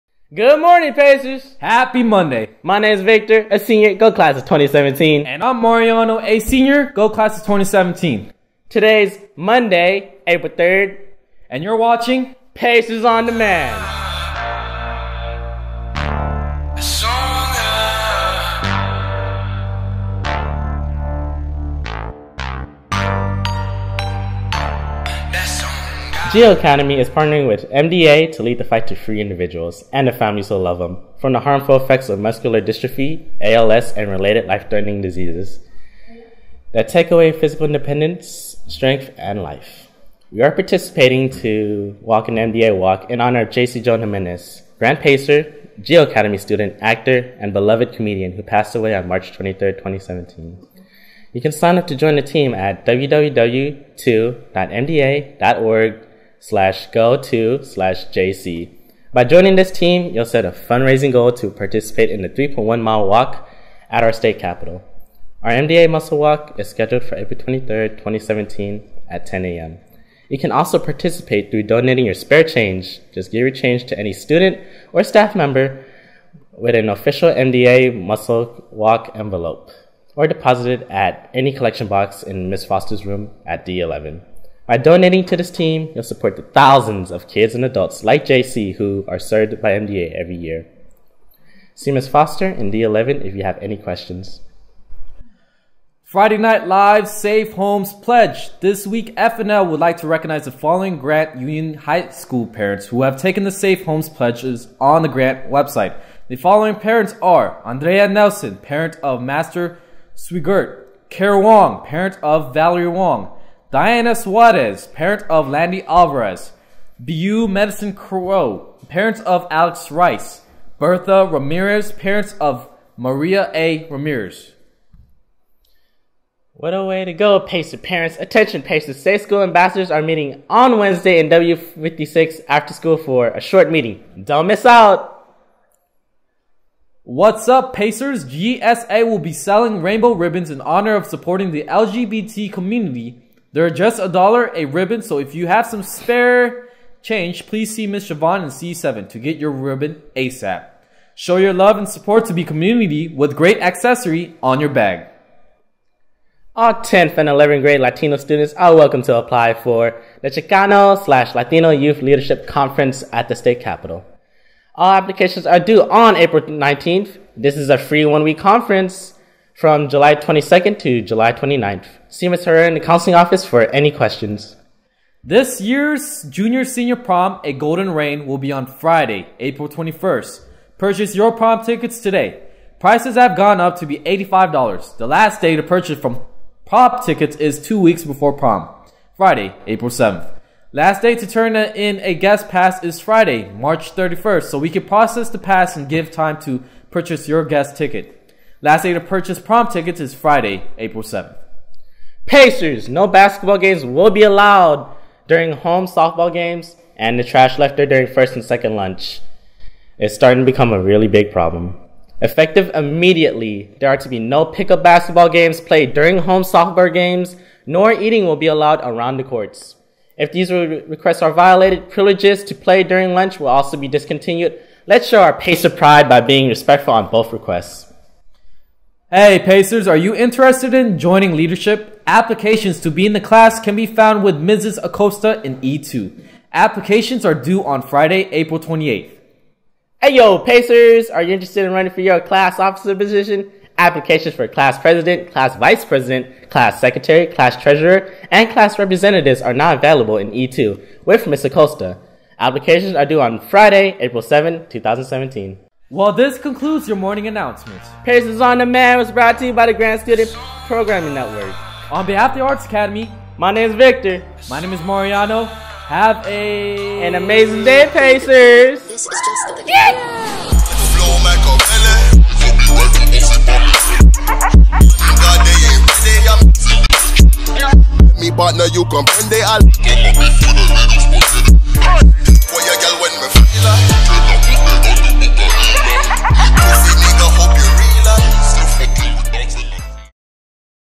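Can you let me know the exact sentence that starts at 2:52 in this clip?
Herrera in the counseling office for any questions.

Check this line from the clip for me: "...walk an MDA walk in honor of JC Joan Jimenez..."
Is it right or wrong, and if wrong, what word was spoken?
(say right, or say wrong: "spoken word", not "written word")
right.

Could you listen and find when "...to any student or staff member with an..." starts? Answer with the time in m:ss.
1:13.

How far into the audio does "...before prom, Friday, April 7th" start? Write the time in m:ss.
3:08.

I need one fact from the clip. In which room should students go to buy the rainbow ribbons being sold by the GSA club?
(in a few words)
C7.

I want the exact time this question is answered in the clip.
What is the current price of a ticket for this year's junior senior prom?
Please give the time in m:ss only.
3:03.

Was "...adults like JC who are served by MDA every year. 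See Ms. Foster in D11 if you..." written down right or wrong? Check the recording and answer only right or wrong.
right.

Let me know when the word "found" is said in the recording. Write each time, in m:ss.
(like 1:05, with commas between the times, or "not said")
3:53.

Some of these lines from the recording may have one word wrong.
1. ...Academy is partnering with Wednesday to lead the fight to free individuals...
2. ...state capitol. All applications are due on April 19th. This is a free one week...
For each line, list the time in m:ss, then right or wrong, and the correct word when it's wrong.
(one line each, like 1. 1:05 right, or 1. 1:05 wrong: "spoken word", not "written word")
1. 0:26 wrong: "MDA", not "Wednesday"
2. 2:43 right.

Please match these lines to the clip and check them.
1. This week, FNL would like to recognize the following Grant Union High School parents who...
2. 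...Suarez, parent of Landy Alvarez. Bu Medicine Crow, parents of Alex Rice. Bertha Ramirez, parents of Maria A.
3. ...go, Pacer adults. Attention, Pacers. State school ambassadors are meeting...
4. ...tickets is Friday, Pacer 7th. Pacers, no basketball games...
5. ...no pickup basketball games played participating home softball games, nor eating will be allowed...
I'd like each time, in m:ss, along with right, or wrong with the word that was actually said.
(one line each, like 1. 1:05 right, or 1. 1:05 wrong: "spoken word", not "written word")
1. 1:38 right
2. 1:54 right
3. 2:07 wrong: "parents", not "adults"
4. 3:19 wrong: "April", not "Pacer"
5. 3:34 wrong: "during", not "participating".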